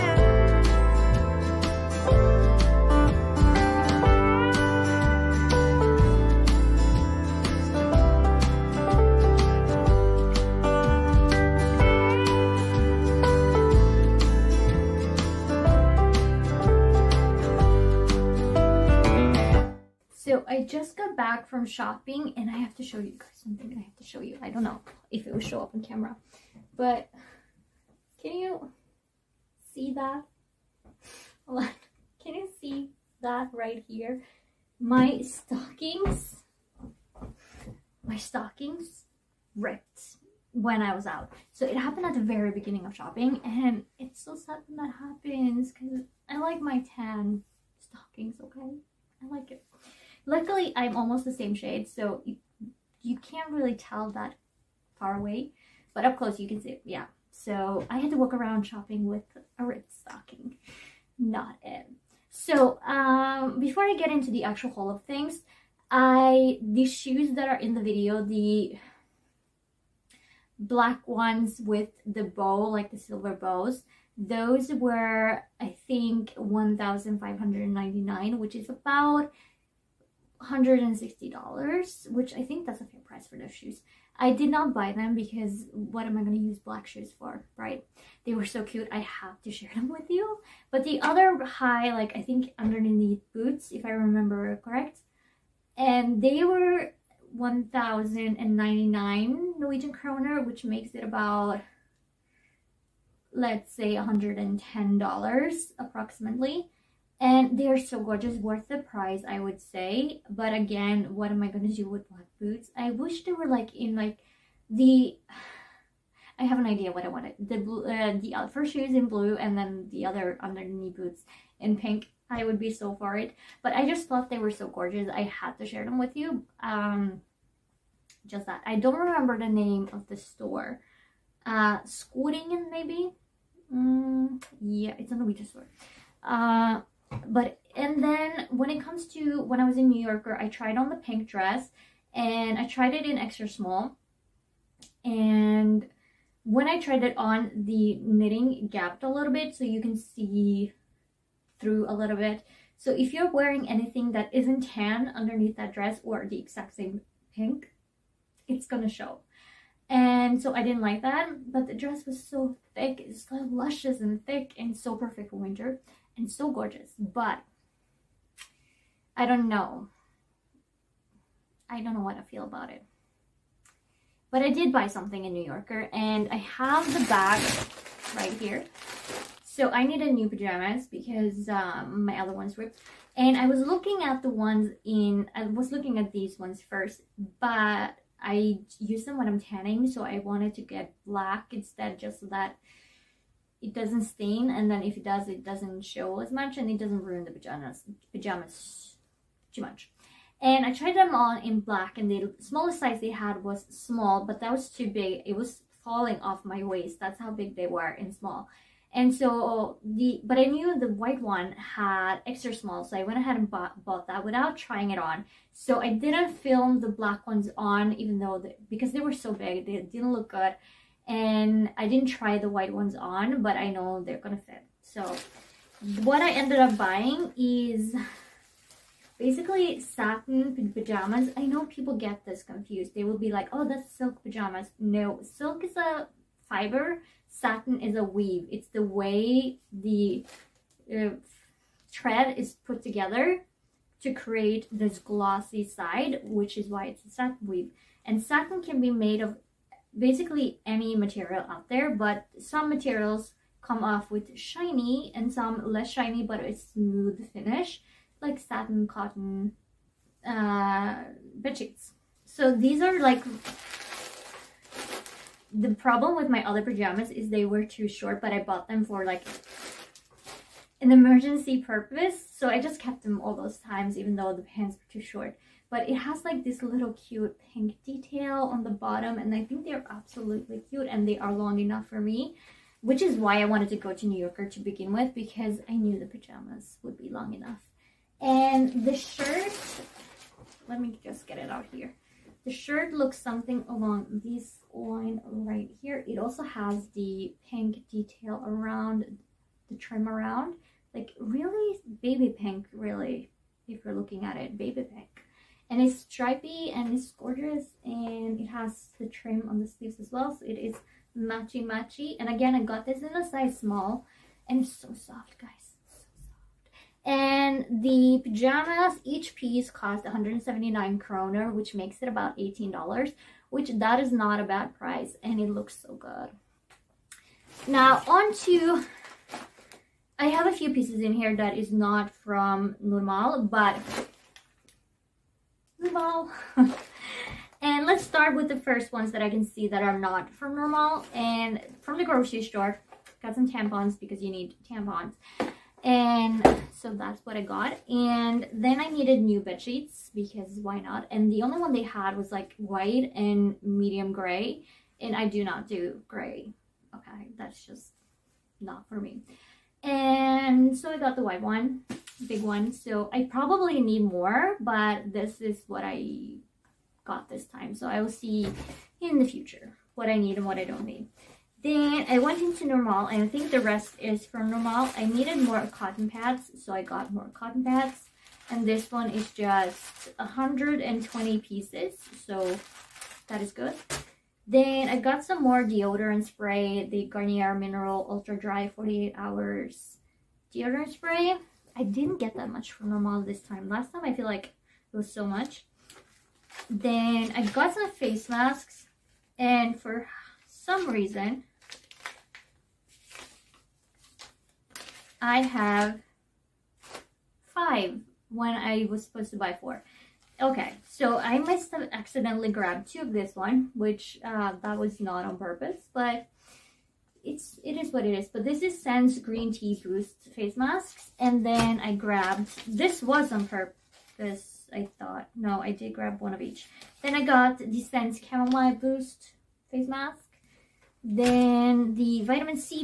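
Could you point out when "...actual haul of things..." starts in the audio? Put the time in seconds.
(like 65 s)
64 s.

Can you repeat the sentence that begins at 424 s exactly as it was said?
I thought no, I did grab one of each.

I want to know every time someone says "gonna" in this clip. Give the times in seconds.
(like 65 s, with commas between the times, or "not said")
111 s, 158 s, 224 s.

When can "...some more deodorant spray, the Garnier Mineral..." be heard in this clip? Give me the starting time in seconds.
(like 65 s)
385 s.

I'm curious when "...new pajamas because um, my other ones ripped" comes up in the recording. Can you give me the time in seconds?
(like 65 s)
180 s.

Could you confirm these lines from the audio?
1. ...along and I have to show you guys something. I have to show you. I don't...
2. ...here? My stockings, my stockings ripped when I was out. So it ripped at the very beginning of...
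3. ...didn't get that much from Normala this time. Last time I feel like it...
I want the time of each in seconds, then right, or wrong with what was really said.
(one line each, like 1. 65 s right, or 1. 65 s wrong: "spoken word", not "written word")
1. 21 s wrong: "shopping", not "along"
2. 33 s wrong: "happened", not "ripped"
3. 391 s right.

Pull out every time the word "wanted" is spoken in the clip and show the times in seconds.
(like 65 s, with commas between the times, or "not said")
117 s, 190 s, 283 s.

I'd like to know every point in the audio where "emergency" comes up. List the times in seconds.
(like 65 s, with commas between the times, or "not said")
270 s.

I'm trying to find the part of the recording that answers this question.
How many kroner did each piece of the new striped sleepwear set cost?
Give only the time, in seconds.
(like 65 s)
320 s.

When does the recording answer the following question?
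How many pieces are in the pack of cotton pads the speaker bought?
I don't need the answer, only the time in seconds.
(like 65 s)
380 s.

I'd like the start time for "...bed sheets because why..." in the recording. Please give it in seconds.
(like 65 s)
349 s.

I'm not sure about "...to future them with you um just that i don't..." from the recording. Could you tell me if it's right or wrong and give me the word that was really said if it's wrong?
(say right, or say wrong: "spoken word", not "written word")
wrong: "share", not "future".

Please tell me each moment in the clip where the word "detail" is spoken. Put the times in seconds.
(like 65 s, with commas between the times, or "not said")
277 s, 297 s.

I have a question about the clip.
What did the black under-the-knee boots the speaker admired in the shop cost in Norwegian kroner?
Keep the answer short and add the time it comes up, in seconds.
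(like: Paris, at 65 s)
1,099, at 97 s.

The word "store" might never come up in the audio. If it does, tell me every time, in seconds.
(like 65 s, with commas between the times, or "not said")
130 s, 135 s, 342 s.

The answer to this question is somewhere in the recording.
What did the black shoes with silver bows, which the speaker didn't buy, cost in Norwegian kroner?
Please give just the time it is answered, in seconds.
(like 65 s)
76 s.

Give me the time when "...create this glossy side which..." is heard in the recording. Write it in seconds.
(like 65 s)
244 s.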